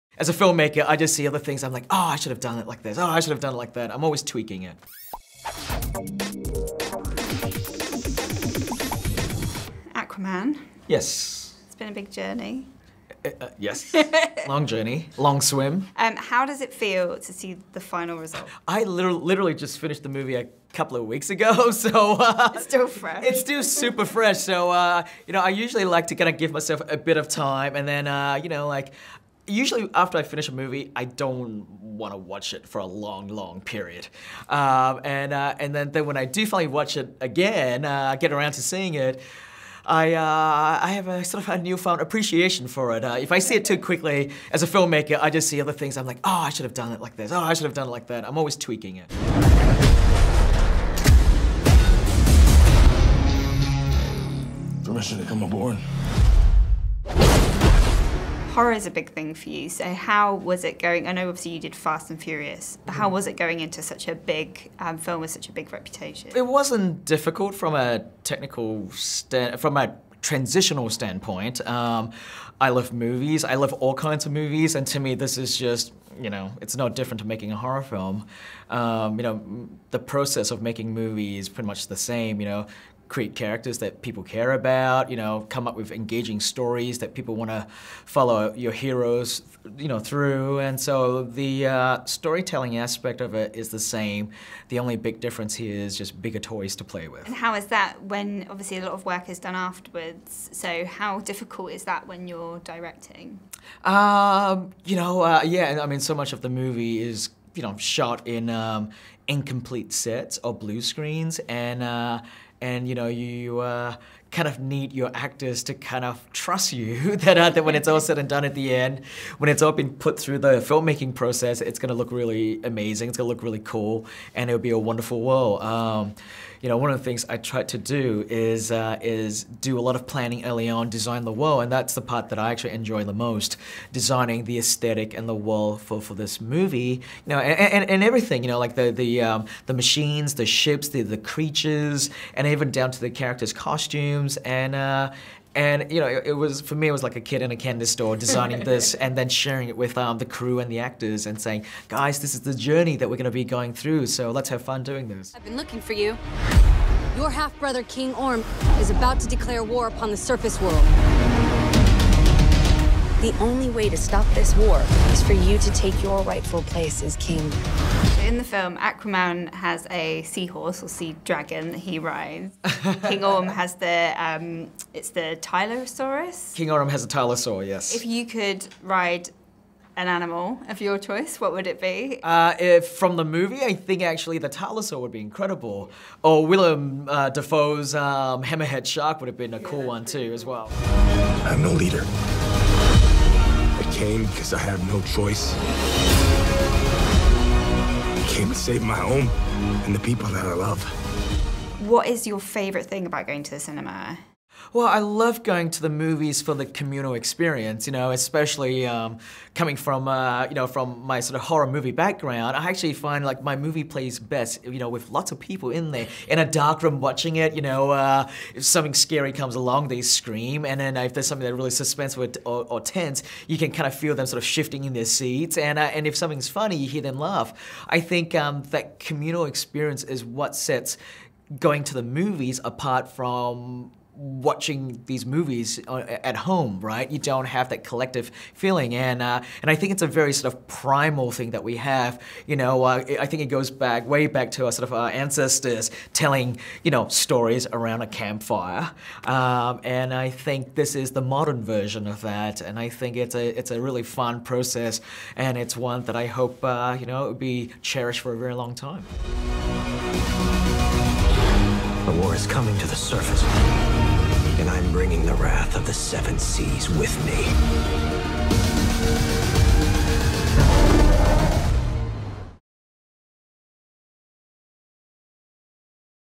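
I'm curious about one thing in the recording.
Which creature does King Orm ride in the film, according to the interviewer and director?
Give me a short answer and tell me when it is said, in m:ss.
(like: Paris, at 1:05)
Tylosaurus, at 2:55.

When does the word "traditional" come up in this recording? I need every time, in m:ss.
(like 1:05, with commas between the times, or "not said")
not said.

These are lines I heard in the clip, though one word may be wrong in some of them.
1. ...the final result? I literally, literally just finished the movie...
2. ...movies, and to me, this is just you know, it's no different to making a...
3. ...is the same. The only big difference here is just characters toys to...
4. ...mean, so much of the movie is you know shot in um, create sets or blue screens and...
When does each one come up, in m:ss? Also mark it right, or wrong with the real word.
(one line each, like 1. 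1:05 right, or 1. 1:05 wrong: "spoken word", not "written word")
1. 0:17 right
2. 1:14 right
3. 1:33 wrong: "bigger", not "characters"
4. 1:45 wrong: "incomplete", not "create".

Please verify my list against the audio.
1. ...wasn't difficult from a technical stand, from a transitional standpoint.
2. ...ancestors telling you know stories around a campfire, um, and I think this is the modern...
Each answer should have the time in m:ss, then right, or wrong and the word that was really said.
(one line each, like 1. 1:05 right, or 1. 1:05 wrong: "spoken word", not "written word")
1. 1:06 right
2. 4:05 right.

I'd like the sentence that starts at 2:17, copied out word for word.
You know, and, and, and everything.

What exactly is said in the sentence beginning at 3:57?
You don't have that collective feeling, and uh, and I think it's a very sort of primal thing that we have.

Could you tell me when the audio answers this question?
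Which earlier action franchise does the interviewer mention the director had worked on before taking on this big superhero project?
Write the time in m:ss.
1:01.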